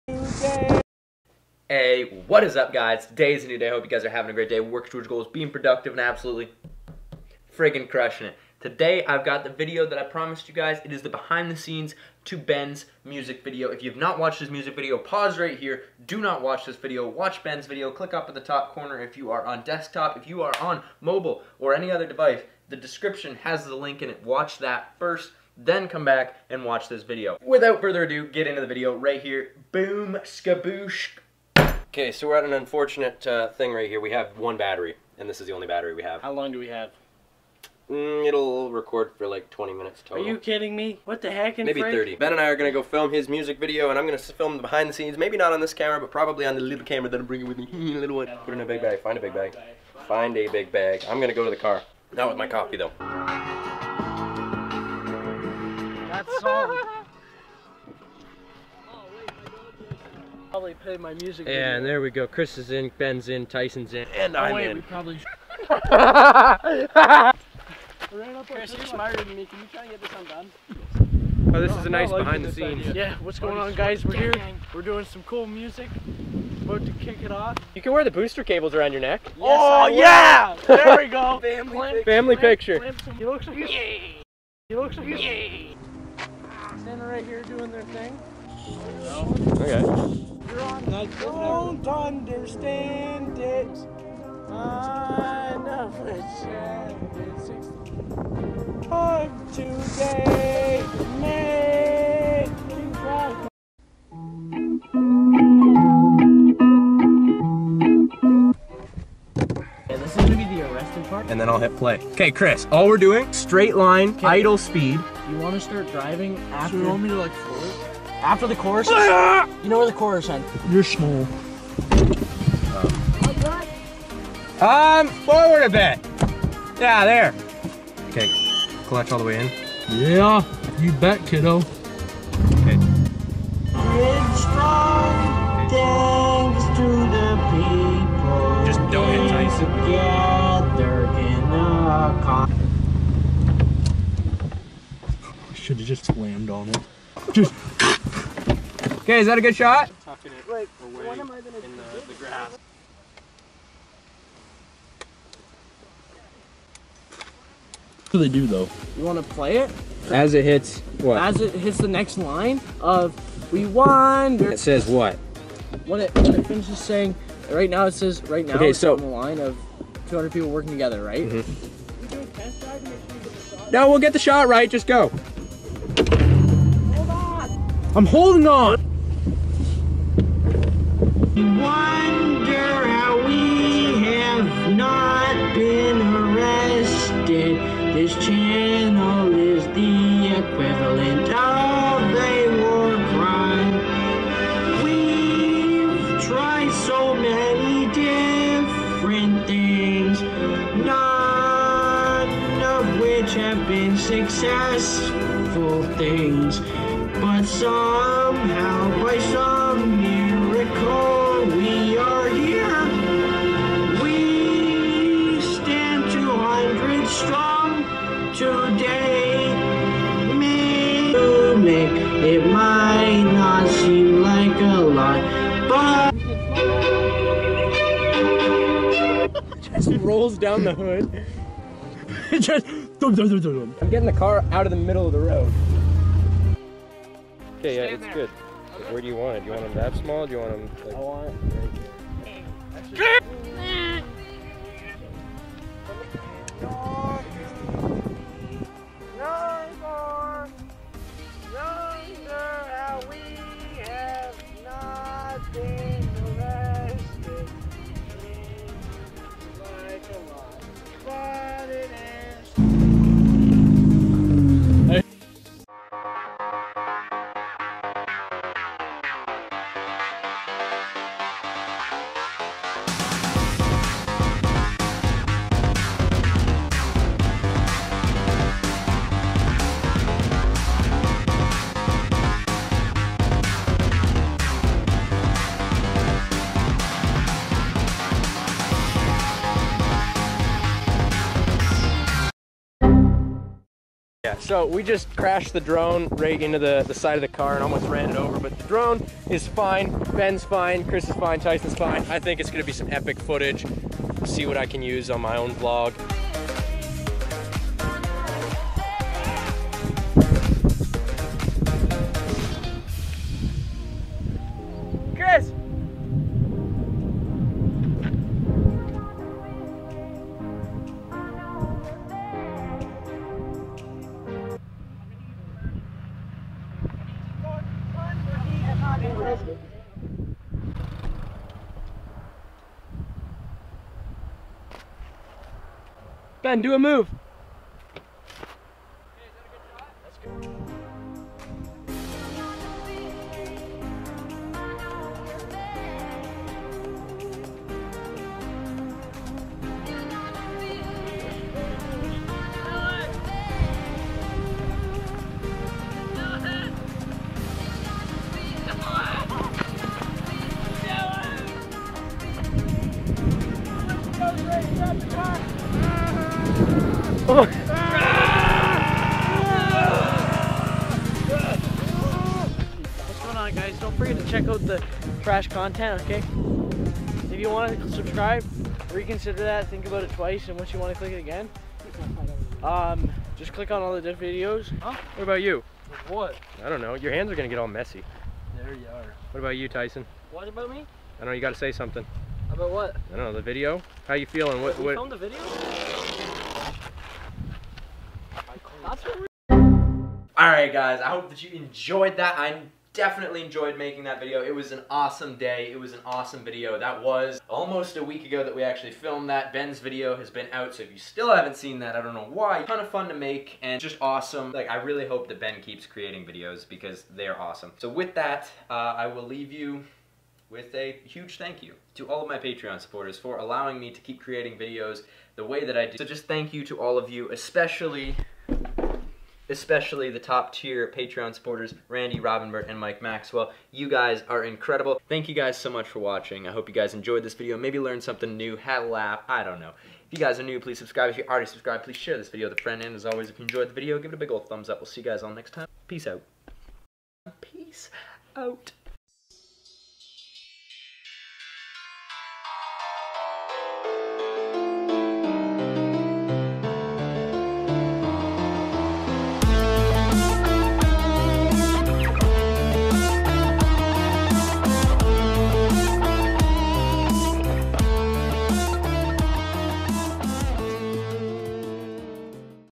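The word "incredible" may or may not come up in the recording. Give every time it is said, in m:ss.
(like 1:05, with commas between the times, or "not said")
7:14.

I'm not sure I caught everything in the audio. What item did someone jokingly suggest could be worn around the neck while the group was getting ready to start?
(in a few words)
booster cables.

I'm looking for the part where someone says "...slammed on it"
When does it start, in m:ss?
2:26.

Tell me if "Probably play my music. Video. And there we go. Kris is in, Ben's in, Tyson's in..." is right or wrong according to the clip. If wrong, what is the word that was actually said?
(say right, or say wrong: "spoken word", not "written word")
right.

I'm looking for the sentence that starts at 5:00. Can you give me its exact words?
Ben's fine, Kris is fine, Tyson's fine.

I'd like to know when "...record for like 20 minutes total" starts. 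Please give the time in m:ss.
0:38.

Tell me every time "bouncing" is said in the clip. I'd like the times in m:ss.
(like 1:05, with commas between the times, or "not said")
not said.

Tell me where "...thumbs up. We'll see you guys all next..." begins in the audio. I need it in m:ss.
7:24.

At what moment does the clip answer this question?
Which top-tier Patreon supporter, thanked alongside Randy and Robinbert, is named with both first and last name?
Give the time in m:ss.
7:12.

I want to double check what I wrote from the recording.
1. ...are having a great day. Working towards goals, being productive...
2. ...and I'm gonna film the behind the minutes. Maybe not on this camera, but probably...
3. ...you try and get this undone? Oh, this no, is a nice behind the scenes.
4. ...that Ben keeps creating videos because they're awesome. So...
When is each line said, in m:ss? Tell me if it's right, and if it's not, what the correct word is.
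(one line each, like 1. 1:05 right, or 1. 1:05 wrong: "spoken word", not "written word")
1. 0:04 right
2. 0:43 wrong: "scenes", not "minutes"
3. 1:09 right
4. 6:55 right.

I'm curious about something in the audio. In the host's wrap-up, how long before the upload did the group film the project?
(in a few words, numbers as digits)
almost a week ago.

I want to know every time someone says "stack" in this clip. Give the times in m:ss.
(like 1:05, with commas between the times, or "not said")
not said.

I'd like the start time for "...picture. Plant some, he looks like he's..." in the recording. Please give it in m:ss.
1:22.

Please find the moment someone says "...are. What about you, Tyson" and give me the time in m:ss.
6:28.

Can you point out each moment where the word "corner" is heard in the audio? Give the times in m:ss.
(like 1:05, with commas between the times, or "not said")
0:18.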